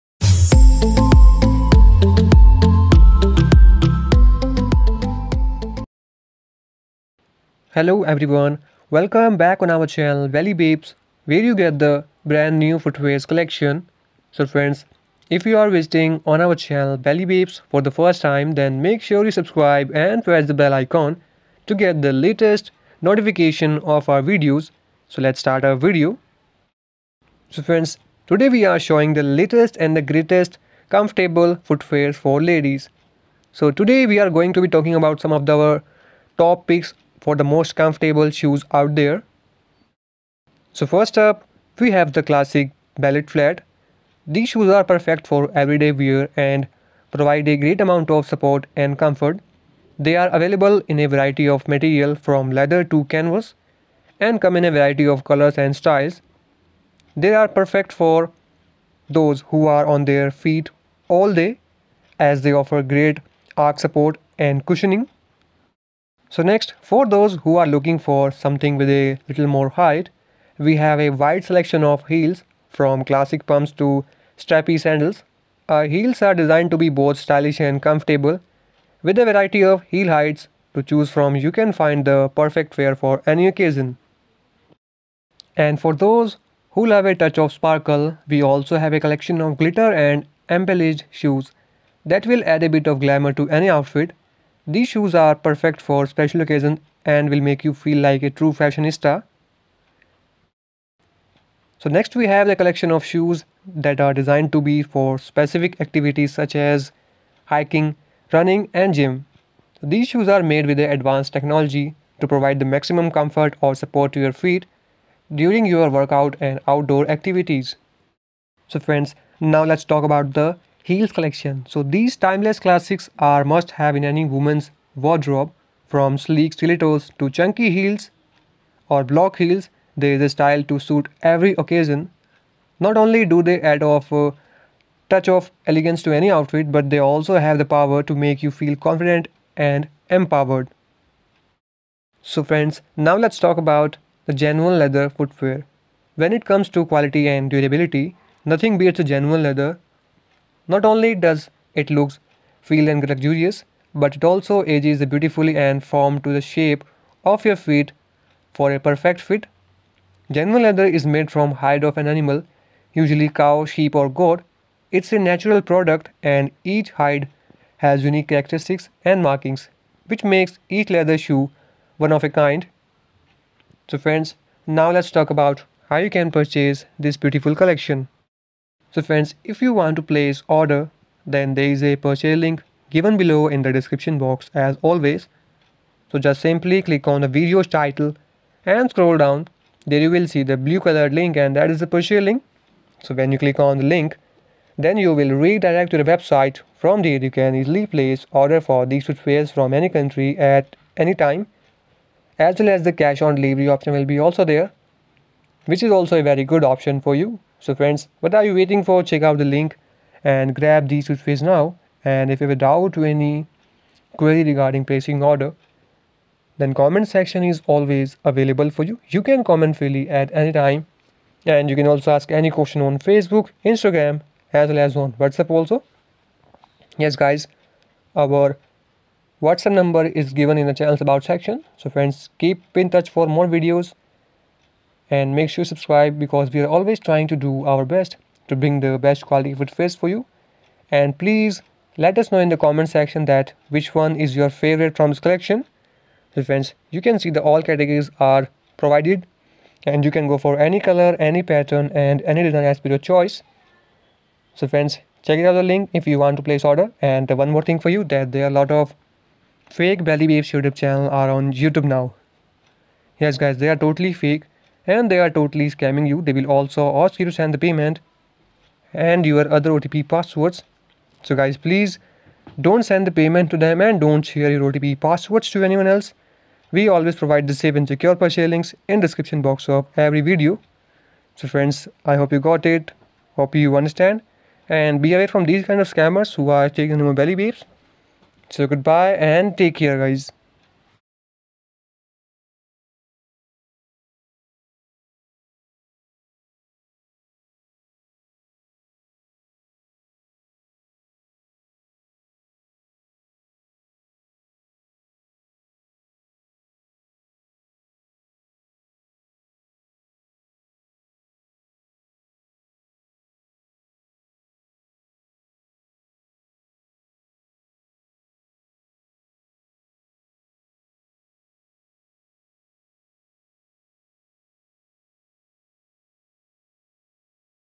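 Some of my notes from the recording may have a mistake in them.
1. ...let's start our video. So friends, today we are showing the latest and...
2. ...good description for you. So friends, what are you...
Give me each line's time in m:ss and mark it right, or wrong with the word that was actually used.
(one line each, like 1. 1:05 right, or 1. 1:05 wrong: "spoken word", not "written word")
1. 0:25 right
2. 3:26 wrong: "option", not "description".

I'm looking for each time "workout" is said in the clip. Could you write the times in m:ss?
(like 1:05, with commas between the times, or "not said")
1:55.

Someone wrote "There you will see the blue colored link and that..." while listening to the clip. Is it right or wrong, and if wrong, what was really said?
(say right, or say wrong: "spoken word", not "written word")
right.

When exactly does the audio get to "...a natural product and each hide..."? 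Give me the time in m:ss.
2:45.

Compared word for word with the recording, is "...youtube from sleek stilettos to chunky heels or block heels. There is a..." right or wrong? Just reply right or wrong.
wrong.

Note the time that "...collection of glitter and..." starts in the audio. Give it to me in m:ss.
1:29.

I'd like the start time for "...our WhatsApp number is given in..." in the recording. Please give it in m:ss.
3:48.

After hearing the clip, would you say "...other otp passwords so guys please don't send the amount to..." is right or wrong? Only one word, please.
wrong.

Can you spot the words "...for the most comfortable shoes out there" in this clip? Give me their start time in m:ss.
0:37.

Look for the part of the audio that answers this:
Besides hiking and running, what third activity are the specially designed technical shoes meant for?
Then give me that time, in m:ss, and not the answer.
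1:48.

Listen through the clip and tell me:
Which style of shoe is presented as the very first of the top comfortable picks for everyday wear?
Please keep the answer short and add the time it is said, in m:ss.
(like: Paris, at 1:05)
ballet flat, at 0:42.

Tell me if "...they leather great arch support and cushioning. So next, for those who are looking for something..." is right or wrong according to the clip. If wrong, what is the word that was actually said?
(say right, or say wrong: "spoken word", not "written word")
wrong: "offer", not "leather".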